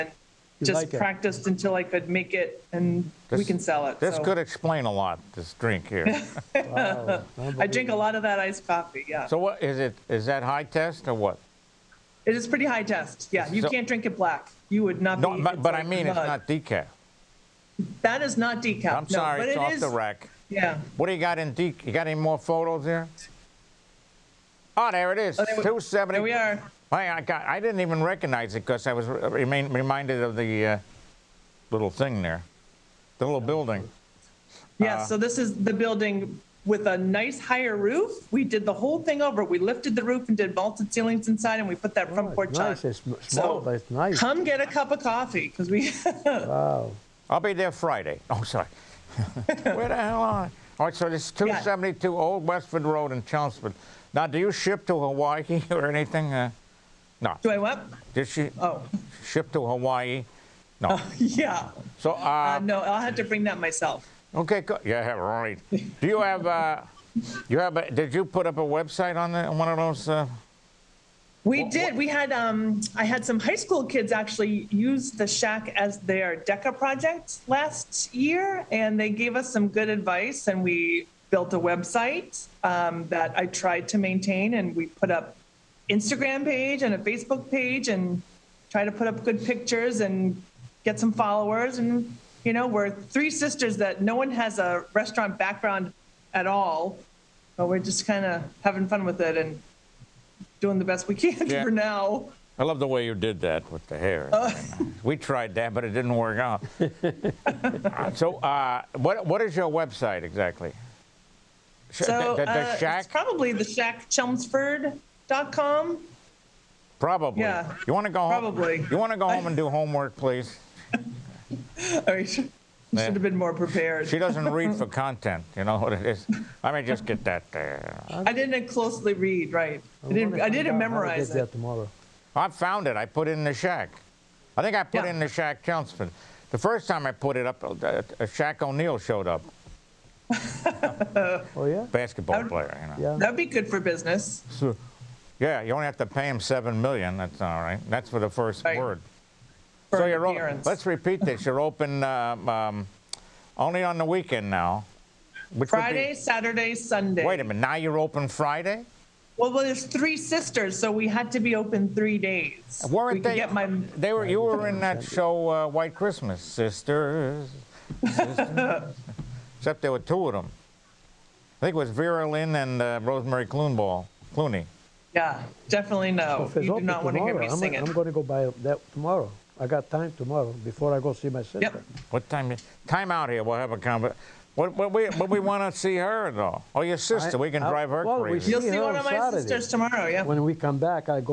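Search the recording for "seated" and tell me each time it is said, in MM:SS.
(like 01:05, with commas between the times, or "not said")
not said.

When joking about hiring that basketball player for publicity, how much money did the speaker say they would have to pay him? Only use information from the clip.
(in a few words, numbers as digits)
7 million.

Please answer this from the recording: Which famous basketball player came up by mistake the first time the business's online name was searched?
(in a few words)
Shaq O'Neal.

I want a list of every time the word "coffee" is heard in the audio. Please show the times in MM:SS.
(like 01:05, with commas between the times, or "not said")
00:08, 00:44.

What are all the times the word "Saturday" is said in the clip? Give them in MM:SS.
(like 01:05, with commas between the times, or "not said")
02:36, 03:09.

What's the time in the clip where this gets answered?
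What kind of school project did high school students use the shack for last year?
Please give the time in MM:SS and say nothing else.
01:16.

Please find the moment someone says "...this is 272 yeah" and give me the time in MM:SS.
00:51.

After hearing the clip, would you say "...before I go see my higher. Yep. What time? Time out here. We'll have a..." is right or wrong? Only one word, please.
wrong.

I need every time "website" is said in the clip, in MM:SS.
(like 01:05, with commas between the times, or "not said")
01:08, 01:21, 01:49.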